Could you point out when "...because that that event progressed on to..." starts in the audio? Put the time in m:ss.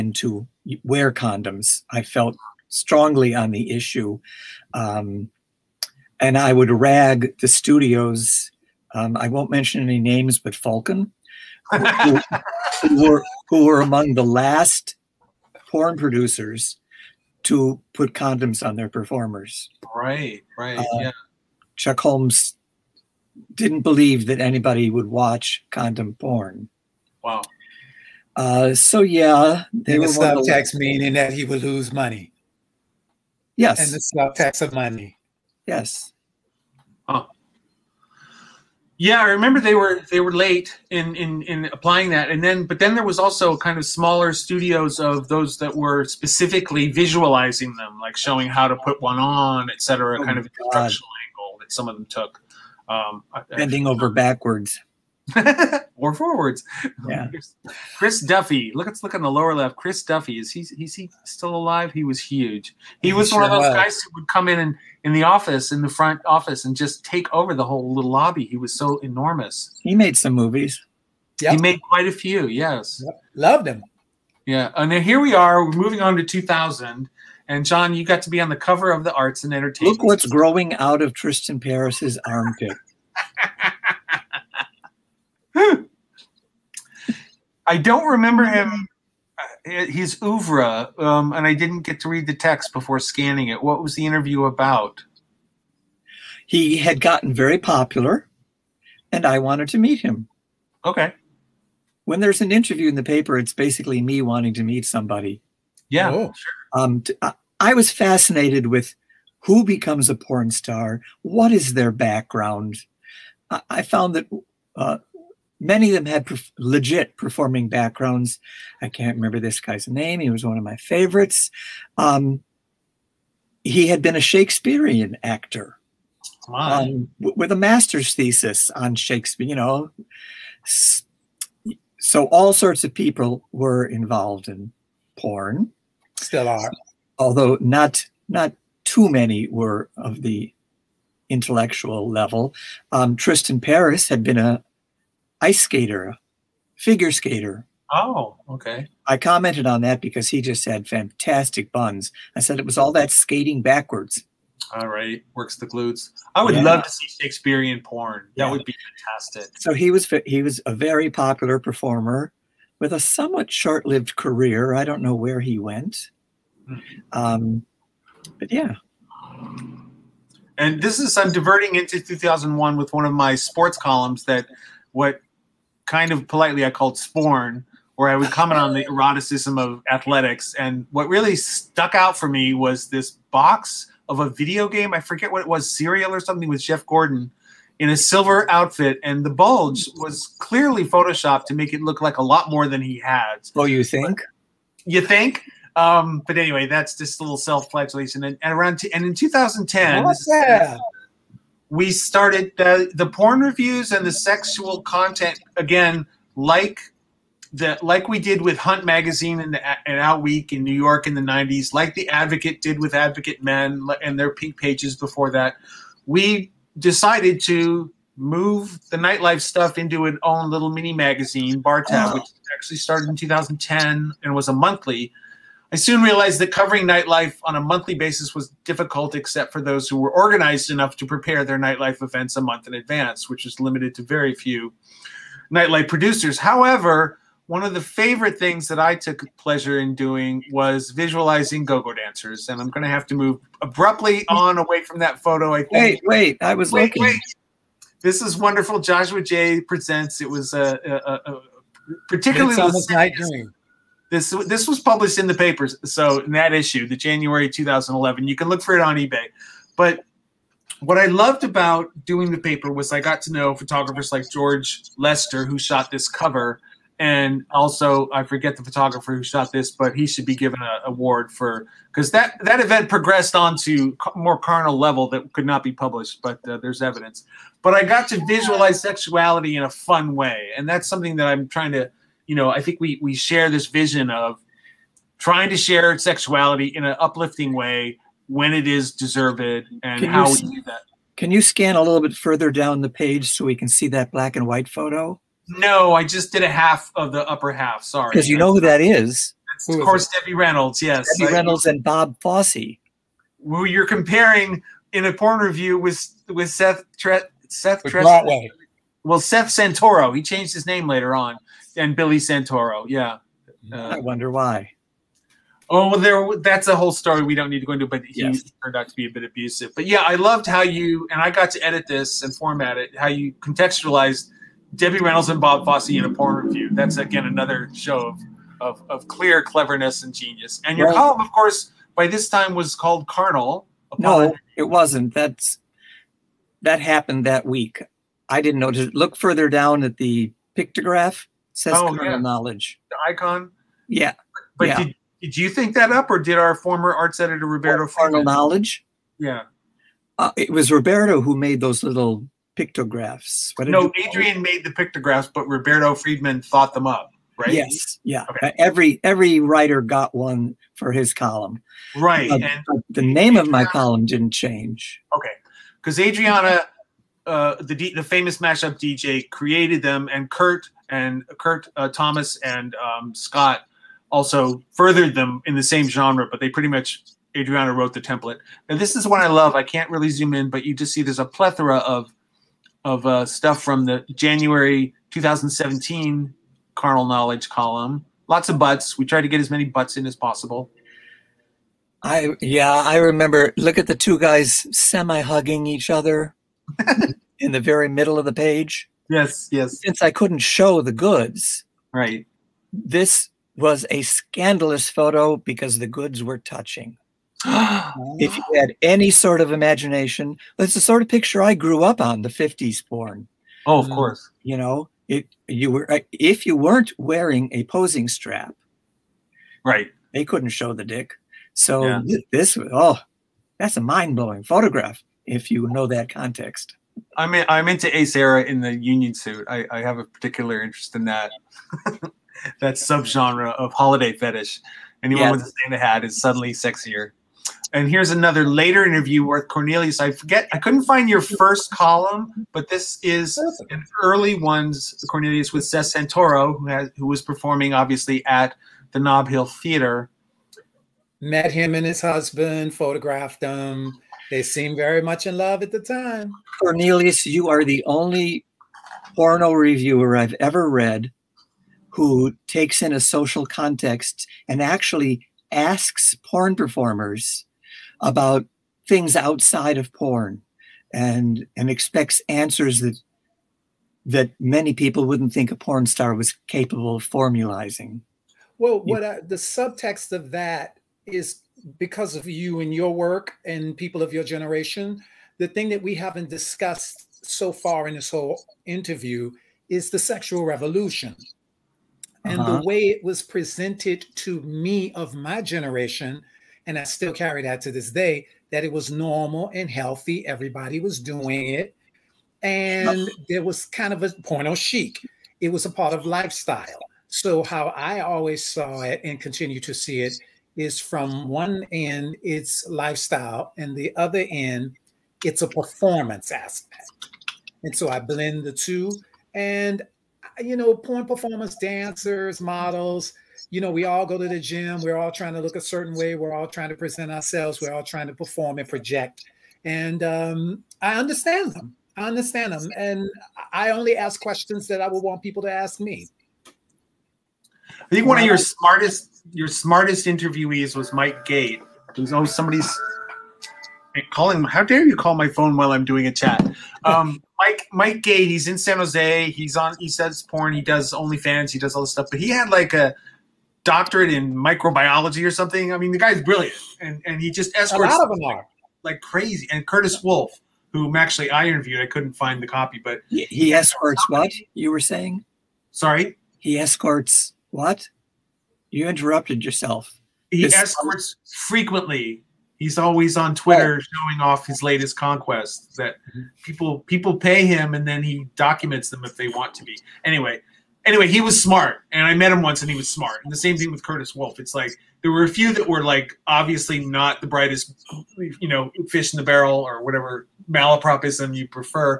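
4:31.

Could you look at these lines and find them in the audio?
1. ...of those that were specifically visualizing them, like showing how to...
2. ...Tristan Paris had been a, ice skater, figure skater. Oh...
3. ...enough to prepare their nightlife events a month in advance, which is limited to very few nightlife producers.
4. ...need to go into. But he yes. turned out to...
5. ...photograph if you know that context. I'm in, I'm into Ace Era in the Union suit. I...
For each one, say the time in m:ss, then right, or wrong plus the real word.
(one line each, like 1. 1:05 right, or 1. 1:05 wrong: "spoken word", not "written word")
1. 0:44 right
2. 2:23 right
3. 3:50 right
4. 5:17 right
5. 7:04 right.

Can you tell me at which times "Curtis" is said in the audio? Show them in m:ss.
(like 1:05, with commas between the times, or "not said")
9:19, 9:43.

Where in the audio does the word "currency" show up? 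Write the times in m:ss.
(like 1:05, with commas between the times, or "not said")
not said.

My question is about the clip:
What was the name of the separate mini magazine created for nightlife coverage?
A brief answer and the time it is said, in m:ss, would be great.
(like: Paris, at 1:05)
Bar Tab, at 3:41.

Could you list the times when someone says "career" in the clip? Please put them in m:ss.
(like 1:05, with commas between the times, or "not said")
2:44.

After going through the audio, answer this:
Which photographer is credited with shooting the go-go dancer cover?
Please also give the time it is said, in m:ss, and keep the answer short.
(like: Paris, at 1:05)
George Lester, at 4:24.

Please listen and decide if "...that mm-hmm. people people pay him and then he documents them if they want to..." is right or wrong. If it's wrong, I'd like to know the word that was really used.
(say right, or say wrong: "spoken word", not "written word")
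right.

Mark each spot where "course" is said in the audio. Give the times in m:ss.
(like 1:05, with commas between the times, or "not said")
4:59, 5:31, 6:53.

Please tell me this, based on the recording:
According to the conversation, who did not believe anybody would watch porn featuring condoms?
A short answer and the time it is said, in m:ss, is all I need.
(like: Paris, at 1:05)
Chuck Holmes, at 0:21.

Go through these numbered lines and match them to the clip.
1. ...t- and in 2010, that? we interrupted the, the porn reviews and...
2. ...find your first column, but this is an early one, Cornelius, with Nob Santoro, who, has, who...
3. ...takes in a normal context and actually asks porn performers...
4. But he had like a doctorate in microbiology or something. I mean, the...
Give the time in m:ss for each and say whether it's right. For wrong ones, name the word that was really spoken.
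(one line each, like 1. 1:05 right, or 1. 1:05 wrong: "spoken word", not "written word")
1. 3:18 wrong: "started", not "interrupted"
2. 7:20 wrong: "Seth", not "Nob"
3. 7:42 wrong: "social", not "normal"
4. 9:12 right.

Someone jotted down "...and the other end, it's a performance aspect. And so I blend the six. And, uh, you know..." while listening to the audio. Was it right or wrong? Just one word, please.
wrong.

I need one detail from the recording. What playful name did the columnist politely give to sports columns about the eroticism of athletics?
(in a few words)
Sporn.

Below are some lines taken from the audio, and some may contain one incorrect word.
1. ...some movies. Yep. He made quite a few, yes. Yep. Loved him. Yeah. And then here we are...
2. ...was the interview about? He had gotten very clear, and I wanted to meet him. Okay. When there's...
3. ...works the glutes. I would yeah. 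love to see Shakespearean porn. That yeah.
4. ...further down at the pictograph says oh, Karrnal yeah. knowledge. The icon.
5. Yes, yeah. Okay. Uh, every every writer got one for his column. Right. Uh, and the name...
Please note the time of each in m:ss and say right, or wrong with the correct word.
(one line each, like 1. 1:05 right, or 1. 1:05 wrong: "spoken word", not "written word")
1. 1:10 right
2. 1:33 wrong: "popular", not "clear"
3. 2:35 right
4. 5:39 right
5. 5:57 right.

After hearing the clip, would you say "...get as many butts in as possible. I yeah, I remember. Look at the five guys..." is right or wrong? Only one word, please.
wrong.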